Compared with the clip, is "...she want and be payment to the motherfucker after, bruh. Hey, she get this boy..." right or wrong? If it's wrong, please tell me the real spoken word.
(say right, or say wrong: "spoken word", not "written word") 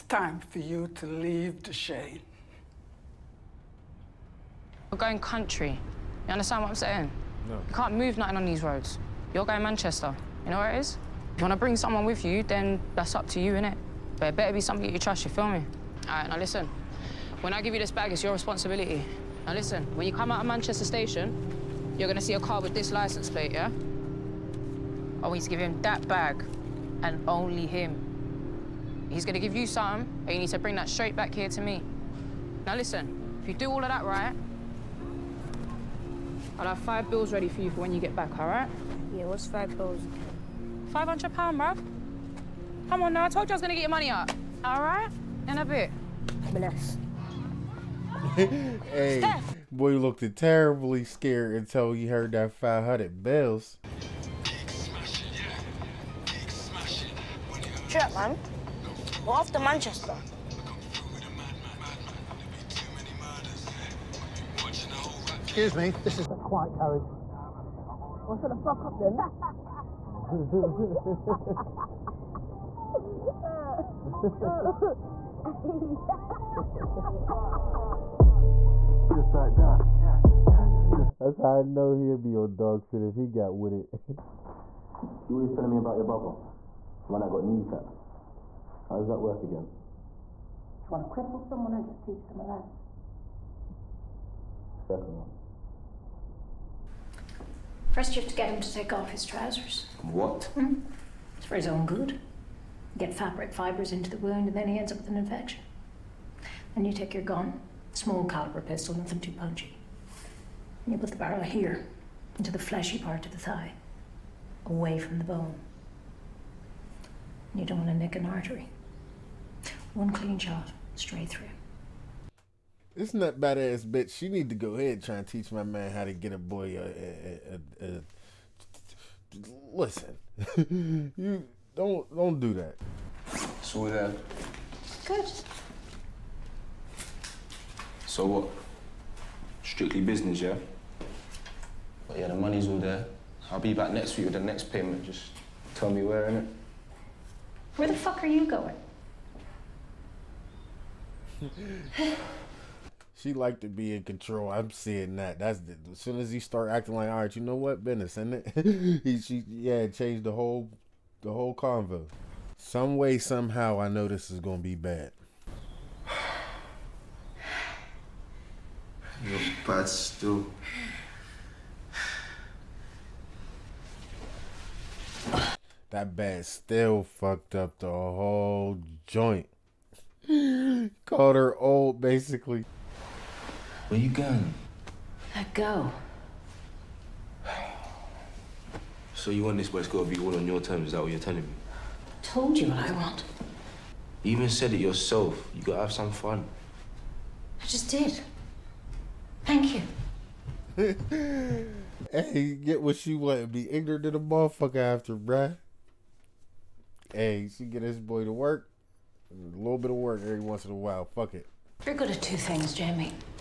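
wrong: "ignorant", not "payment".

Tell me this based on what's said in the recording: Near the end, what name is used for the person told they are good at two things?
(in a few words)
Jamie.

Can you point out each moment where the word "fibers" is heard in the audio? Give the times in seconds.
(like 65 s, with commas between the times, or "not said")
103 s.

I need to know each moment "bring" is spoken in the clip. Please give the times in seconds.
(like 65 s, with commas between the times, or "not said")
11 s, 30 s.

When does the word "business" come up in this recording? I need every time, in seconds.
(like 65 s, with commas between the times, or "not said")
140 s, 157 s.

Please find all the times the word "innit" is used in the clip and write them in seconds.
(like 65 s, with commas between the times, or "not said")
13 s, 146 s.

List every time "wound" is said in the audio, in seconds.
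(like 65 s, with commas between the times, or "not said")
104 s.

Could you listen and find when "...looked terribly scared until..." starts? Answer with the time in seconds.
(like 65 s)
49 s.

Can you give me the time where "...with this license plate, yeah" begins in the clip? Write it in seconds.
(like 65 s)
22 s.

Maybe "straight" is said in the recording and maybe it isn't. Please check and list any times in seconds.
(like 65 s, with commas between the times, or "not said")
30 s, 120 s.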